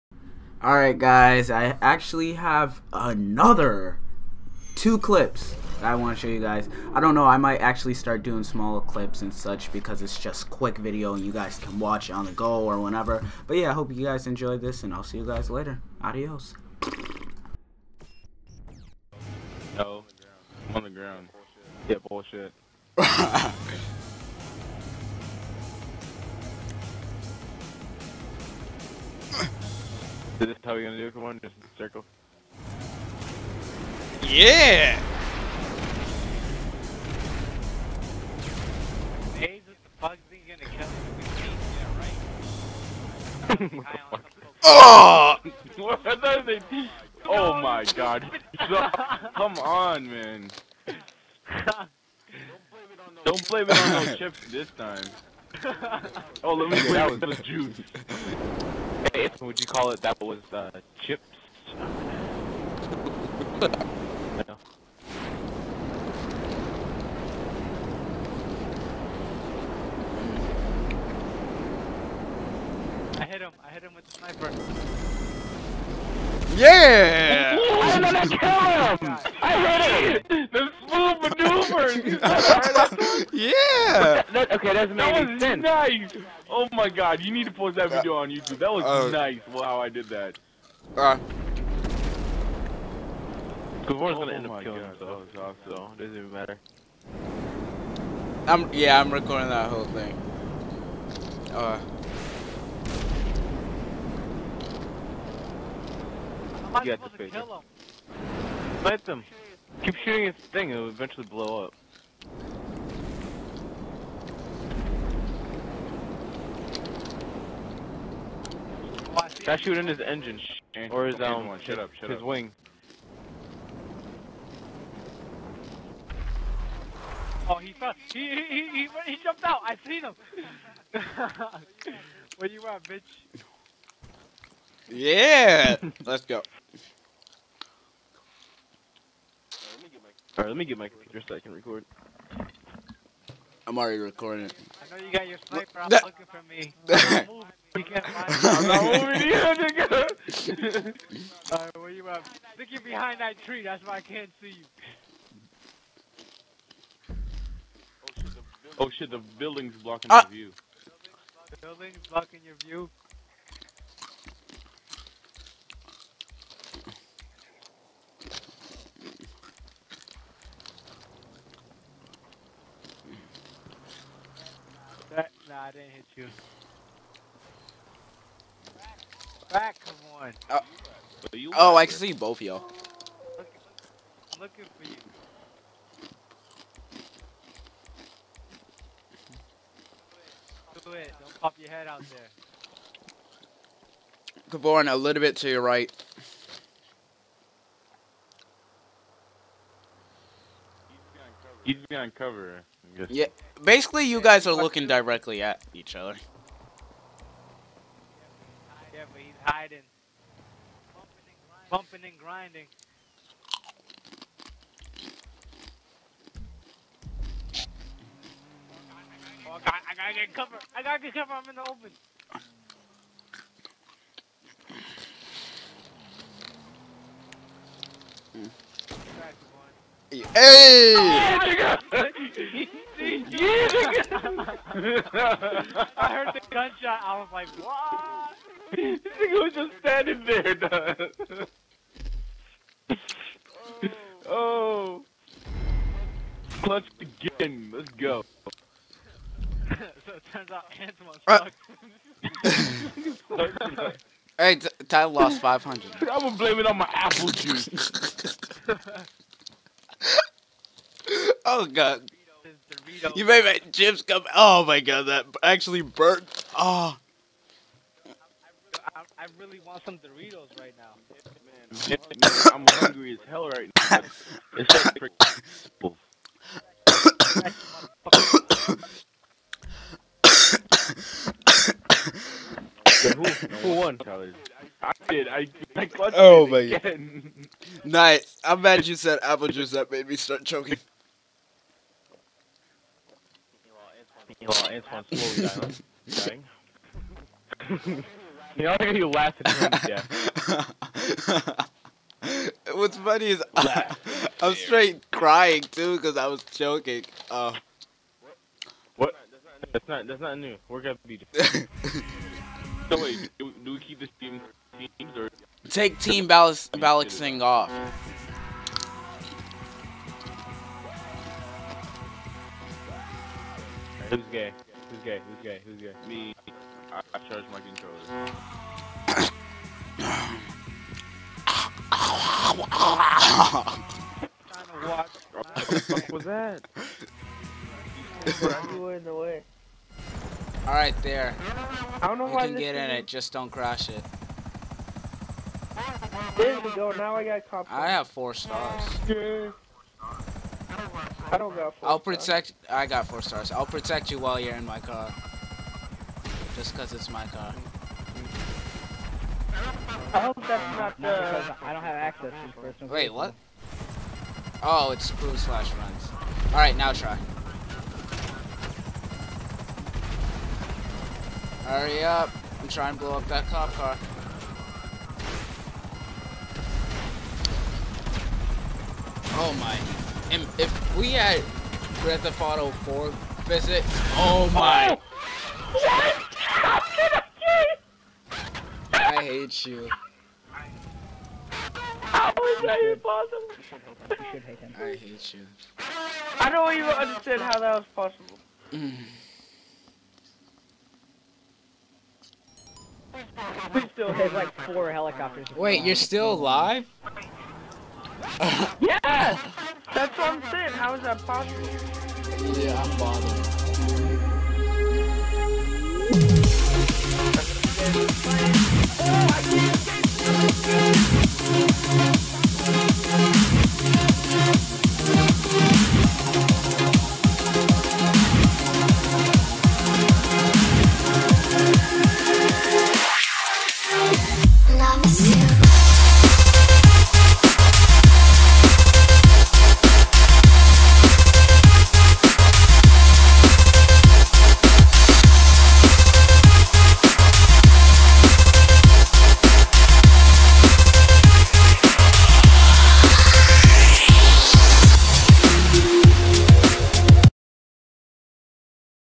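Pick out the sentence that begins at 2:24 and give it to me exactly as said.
I know you got your sniper out looking for me.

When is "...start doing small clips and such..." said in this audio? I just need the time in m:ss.
0:07.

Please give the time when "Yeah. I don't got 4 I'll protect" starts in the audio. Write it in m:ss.
5:49.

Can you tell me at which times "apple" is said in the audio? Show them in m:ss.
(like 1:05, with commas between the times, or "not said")
4:16, 4:49.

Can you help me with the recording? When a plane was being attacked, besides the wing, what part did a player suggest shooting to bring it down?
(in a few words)
engine.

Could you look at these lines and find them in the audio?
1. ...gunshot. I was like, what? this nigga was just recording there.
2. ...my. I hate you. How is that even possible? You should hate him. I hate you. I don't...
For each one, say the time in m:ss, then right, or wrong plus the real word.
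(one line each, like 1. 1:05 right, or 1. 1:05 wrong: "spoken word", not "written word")
1. 3:56 wrong: "standing", not "recording"
2. 6:24 right.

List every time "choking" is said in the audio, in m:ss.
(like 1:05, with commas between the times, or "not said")
4:50, 5:06.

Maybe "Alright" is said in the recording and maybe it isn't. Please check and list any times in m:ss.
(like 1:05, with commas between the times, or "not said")
0:00, 1:30, 2:20, 2:31, 5:40.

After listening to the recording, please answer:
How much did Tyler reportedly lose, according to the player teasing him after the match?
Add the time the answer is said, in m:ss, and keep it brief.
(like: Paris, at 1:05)
500, at 4:15.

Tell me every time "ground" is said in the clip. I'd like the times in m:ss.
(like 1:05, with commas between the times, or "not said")
0:20.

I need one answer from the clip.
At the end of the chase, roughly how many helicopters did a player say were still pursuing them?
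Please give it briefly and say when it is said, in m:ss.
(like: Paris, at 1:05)
4, at 6:44.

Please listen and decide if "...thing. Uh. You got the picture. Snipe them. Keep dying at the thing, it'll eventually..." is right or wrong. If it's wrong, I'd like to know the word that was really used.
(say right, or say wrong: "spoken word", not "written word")
wrong: "shooting", not "dying".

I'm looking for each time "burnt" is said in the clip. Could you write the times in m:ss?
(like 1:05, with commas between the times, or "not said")
4:25.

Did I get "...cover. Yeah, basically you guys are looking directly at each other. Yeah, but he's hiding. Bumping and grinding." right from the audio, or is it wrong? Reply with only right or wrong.
right.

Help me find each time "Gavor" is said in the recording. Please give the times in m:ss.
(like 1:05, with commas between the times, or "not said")
1:33.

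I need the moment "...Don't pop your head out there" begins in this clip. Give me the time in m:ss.
3:10.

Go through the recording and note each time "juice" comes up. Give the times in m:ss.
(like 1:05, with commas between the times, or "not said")
0:57, 4:17, 4:49.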